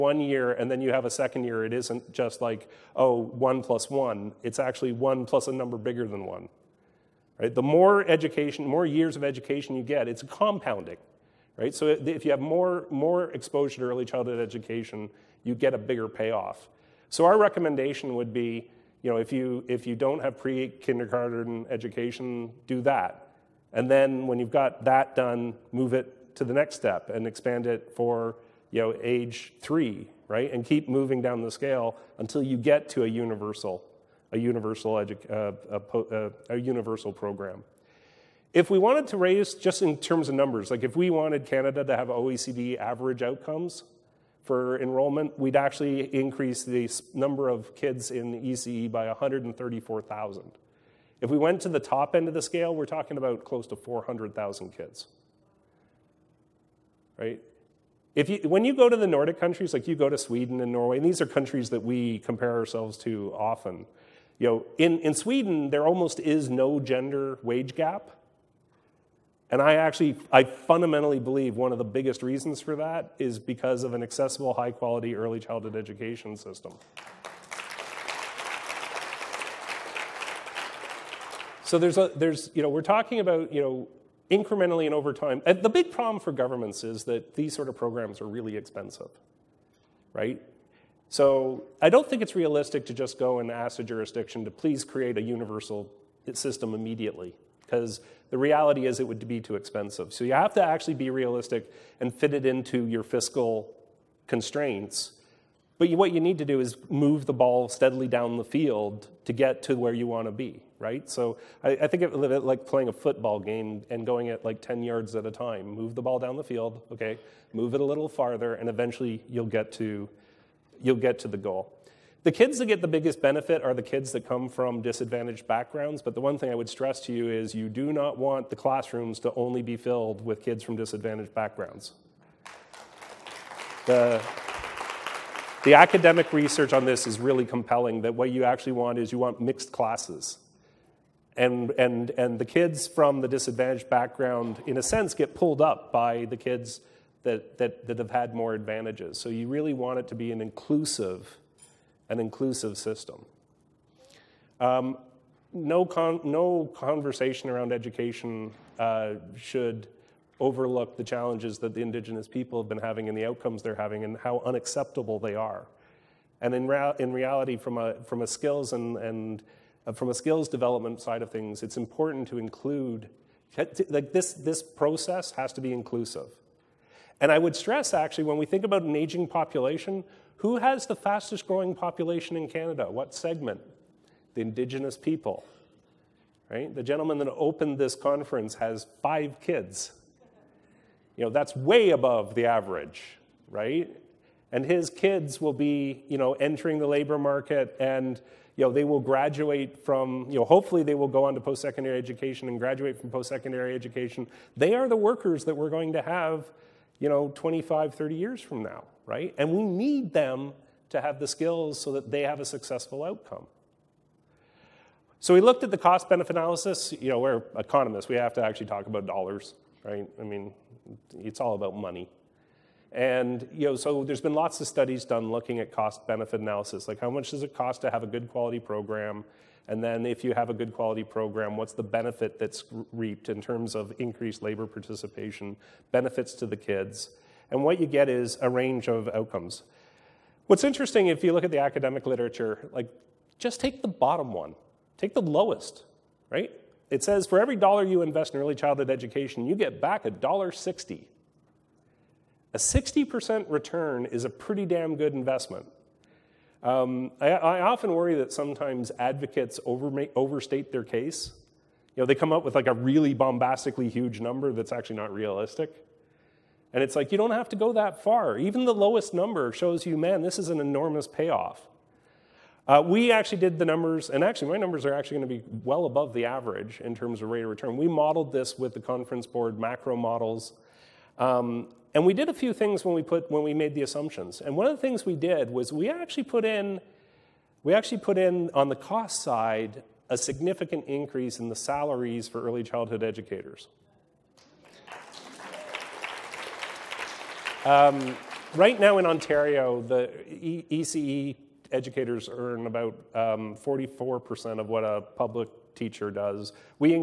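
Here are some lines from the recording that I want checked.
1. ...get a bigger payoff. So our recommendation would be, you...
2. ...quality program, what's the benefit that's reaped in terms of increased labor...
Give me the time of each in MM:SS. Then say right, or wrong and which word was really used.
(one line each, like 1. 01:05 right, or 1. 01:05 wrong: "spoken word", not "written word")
1. 00:15 right
2. 03:50 right.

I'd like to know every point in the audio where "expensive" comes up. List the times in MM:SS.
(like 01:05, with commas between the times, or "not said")
01:28, 01:39.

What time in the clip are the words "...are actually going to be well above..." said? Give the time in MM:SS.
04:34.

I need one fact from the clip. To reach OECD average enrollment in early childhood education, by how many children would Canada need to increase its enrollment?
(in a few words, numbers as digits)
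134,000.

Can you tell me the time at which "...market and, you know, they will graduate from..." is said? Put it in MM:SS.
03:17.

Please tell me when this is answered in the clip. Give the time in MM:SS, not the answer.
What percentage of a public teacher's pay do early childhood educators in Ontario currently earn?
05:03.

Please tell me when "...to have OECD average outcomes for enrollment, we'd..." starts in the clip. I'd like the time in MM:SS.
00:41.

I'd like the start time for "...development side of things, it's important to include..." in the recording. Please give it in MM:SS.
02:50.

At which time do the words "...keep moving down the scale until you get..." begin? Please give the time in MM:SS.
00:30.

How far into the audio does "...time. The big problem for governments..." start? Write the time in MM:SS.
01:25.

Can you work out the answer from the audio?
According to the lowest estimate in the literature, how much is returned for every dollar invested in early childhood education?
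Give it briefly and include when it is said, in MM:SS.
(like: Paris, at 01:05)
$1.60, at 04:10.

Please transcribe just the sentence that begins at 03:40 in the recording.
I mean, it's all about money.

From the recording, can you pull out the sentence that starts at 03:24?
They are the workers that we're going to have, you know, 25, 30 years from now, right?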